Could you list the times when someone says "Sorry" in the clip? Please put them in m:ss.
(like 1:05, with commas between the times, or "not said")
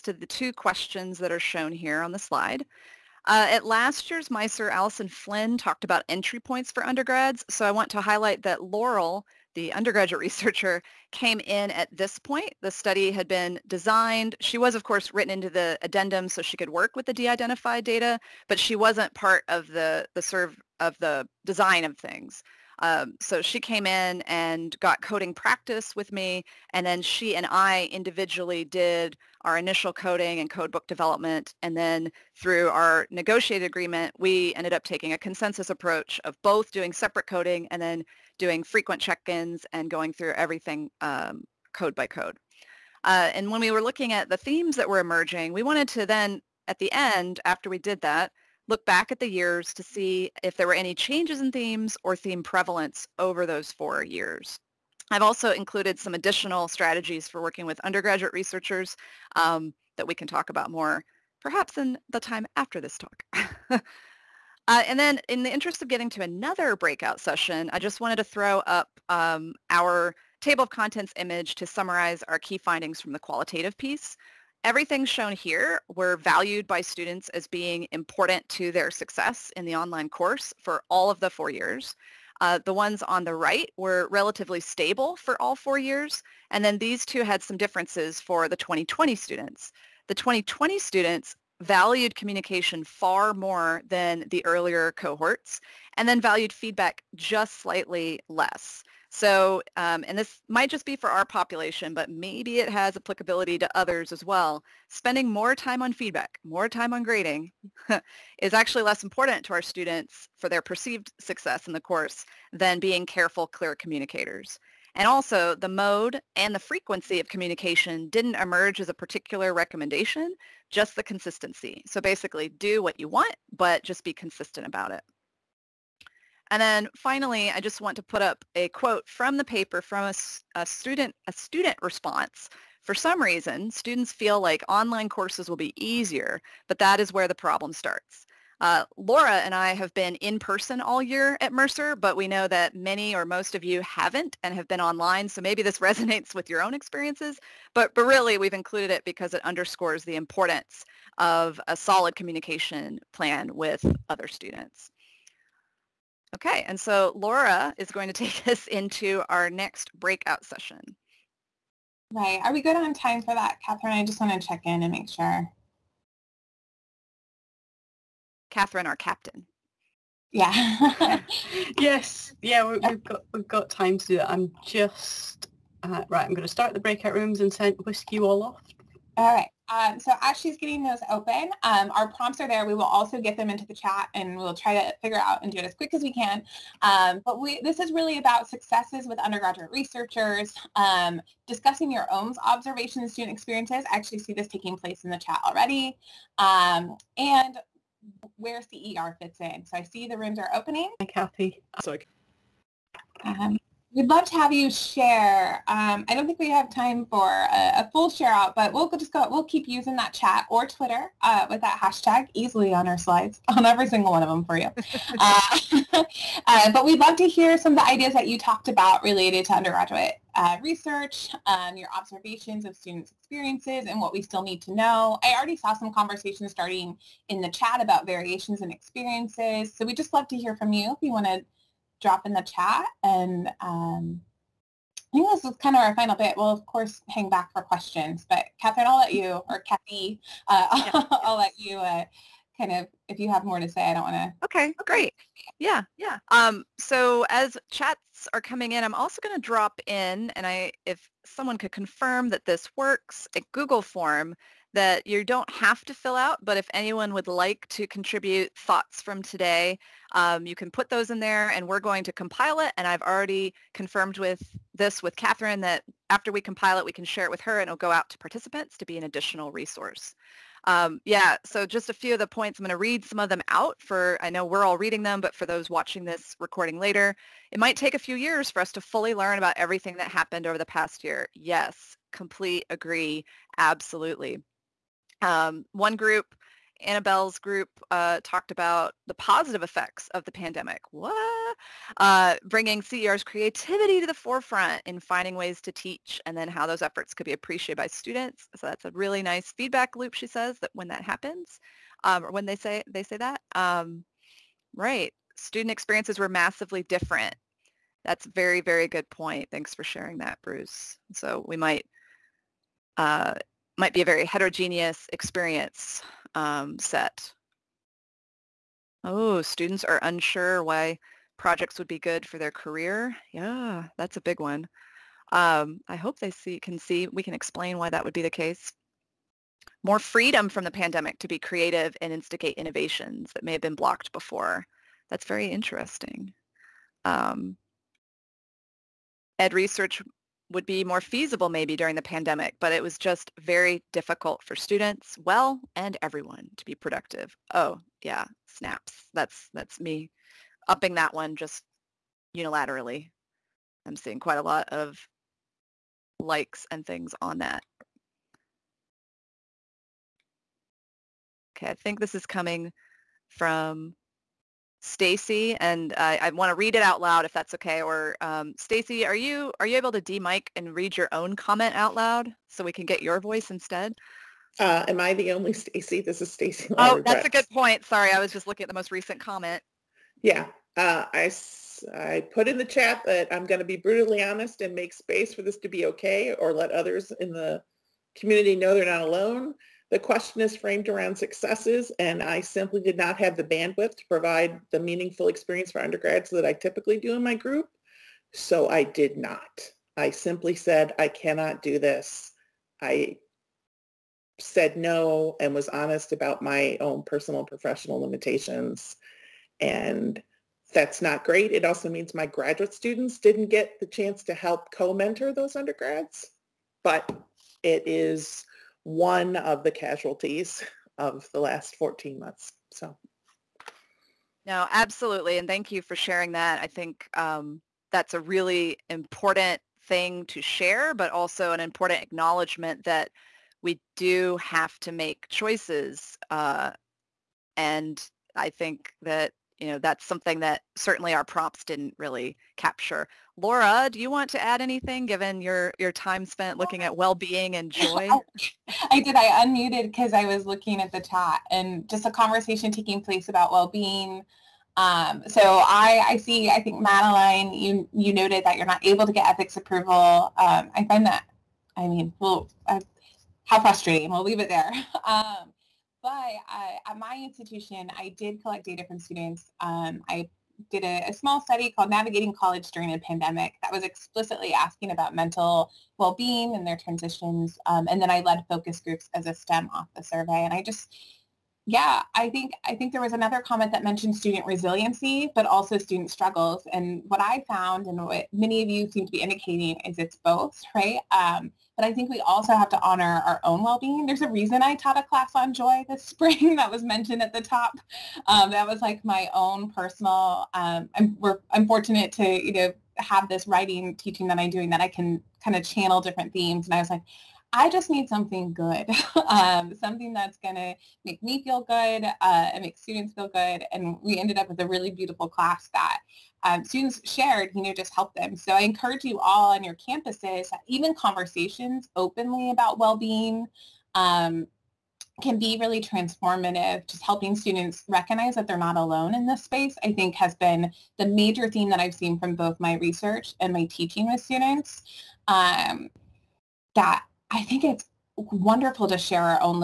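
3:21, 6:17.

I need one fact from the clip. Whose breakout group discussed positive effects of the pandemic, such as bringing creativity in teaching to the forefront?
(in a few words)
Annabelle.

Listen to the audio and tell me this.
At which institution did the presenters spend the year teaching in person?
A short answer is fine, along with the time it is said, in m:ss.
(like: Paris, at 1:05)
Mercer, at 2:21.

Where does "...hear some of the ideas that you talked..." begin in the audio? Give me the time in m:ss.
3:37.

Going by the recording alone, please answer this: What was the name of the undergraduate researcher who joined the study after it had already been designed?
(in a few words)
Laurel.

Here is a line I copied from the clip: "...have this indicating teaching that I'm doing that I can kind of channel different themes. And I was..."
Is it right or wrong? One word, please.
wrong.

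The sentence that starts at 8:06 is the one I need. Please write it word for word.
And what I found, and what many of you seem to be indicating, is it's both, right?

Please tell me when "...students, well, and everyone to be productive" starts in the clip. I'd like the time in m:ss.
5:44.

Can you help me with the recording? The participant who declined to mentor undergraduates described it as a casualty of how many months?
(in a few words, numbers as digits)
14.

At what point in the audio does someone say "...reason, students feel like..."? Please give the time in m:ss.
2:13.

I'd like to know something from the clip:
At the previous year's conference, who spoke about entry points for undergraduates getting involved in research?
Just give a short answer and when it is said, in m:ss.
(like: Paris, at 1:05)
Alison Flynn, at 0:04.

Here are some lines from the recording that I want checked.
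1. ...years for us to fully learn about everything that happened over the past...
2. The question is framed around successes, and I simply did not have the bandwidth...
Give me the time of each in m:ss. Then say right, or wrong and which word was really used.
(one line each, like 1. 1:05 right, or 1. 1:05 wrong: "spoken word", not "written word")
1. 4:38 right
2. 6:29 right.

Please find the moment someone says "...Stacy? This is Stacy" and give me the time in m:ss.
6:15.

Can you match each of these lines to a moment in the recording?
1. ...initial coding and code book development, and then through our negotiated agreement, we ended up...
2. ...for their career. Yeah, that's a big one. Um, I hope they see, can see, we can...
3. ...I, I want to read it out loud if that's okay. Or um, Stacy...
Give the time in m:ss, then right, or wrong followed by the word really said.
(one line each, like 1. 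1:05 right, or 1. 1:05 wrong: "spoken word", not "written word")
1. 0:29 right
2. 5:22 right
3. 6:05 right.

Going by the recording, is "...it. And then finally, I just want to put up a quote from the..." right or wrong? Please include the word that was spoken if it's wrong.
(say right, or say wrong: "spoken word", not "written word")
right.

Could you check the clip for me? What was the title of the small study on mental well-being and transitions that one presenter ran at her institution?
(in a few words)
Navigating College During a Pandemic.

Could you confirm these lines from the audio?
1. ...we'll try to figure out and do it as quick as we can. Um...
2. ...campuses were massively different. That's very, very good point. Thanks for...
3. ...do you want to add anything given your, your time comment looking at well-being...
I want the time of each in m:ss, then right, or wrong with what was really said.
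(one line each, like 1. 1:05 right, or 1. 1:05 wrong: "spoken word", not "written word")
1. 3:04 right
2. 5:05 wrong: "experiences", not "campuses"
3. 7:23 wrong: "spent", not "comment".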